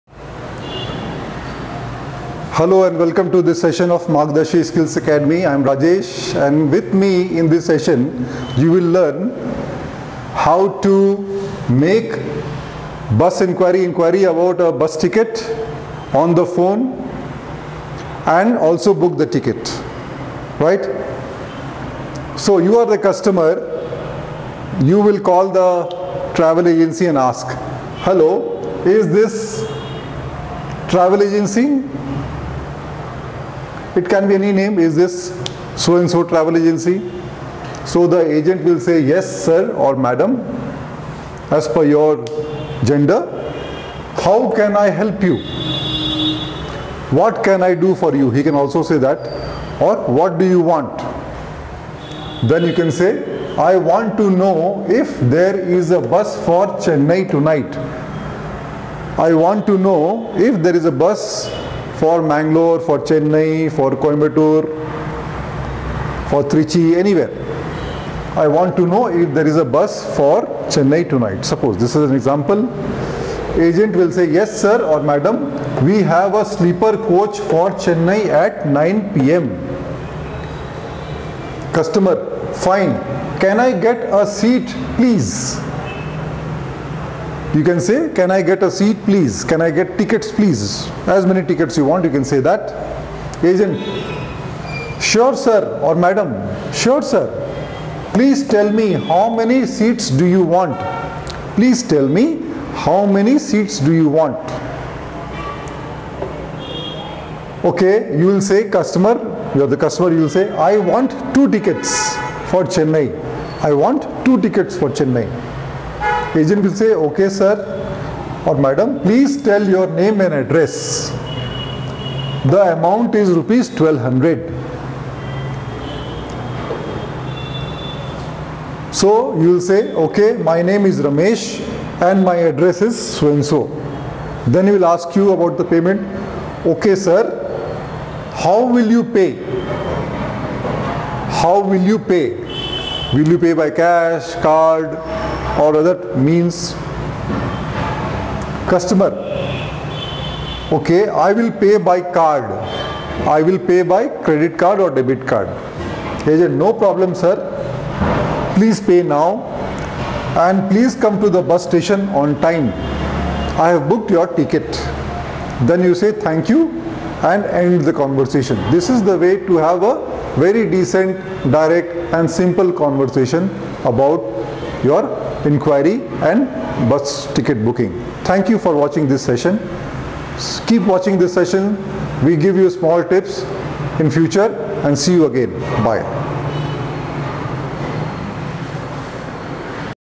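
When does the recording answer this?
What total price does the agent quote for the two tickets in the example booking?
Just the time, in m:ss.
2:03.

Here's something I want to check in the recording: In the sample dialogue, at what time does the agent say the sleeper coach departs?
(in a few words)
9 p.m.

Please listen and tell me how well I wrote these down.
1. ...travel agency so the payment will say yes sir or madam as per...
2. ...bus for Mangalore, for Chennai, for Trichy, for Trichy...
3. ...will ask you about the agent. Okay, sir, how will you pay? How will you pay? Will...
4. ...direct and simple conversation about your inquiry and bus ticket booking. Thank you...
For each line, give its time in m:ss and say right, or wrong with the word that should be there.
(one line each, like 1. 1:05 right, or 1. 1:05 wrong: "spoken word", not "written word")
1. 0:36 wrong: "agent", not "payment"
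2. 1:01 wrong: "Coimbatore", not "Trichy"
3. 2:14 wrong: "payment", not "agent"
4. 2:51 right.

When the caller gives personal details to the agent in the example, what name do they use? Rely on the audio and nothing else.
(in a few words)
Ramesh.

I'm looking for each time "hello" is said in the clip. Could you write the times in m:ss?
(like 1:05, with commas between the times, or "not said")
0:02, 0:28.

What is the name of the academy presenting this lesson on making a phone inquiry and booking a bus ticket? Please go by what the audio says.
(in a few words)
Margdarshi Skills Academy.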